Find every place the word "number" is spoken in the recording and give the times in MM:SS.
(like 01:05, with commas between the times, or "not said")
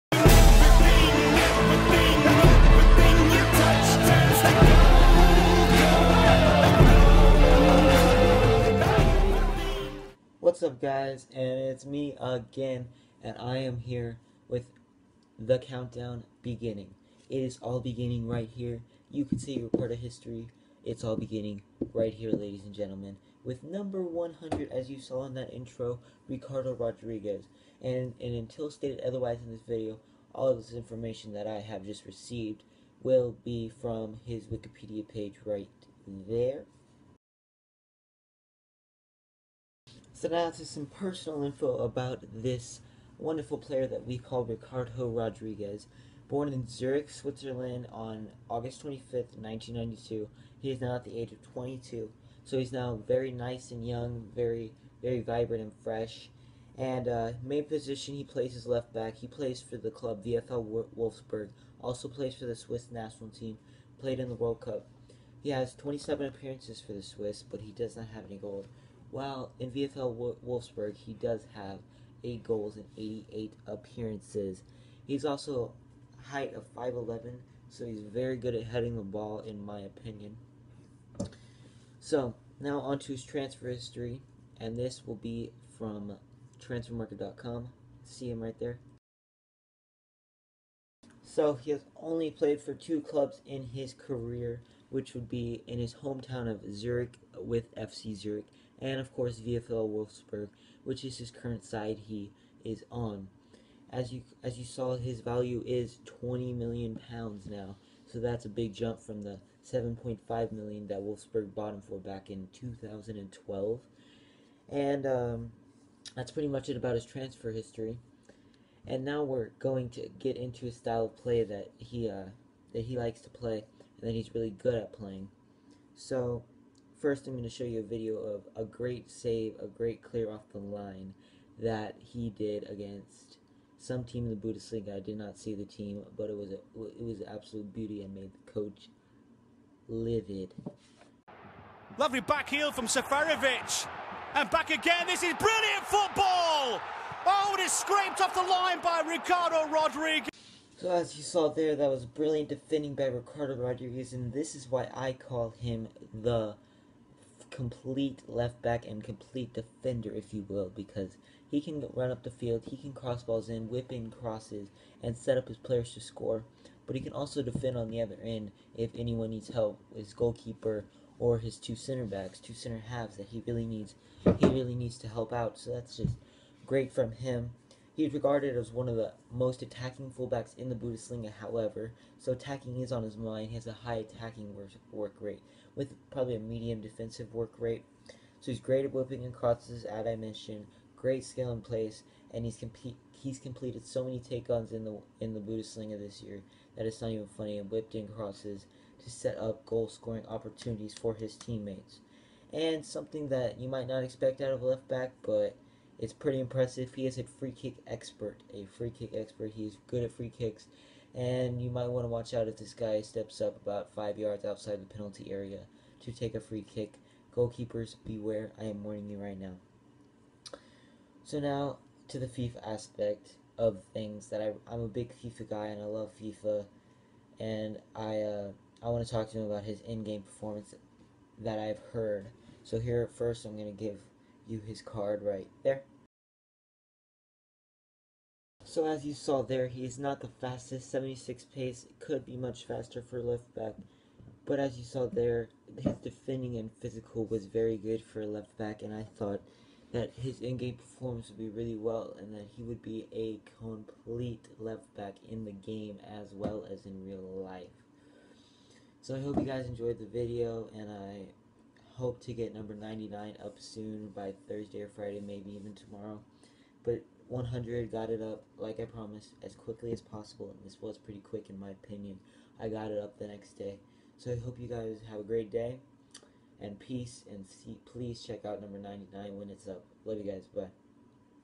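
00:23, 04:22, 04:38.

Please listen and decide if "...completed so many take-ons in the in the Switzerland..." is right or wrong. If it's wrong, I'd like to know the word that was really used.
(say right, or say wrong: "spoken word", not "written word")
wrong: "Bundesliga", not "Switzerland".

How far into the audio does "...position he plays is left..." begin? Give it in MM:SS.
00:57.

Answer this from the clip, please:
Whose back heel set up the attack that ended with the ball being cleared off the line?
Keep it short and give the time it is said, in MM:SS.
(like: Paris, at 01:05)
Safarovic, at 02:22.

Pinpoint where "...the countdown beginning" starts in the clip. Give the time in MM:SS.
00:15.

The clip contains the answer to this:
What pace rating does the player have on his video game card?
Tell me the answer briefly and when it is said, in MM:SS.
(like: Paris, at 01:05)
76, at 04:00.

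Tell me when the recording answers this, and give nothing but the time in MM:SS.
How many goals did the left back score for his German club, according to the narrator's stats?
01:12.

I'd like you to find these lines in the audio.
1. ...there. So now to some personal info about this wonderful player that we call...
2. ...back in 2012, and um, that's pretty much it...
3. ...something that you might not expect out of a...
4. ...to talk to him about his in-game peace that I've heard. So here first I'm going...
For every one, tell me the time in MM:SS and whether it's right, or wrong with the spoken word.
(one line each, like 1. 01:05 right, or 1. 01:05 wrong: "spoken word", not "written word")
1. 00:36 right
2. 01:51 right
3. 03:22 right
4. 03:49 wrong: "performance", not "peace".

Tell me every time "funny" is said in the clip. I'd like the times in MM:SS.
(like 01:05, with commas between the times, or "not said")
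03:17.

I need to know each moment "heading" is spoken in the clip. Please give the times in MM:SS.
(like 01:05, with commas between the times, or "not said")
01:18.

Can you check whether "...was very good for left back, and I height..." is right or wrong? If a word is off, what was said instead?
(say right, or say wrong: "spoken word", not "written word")
wrong: "thought", not "height".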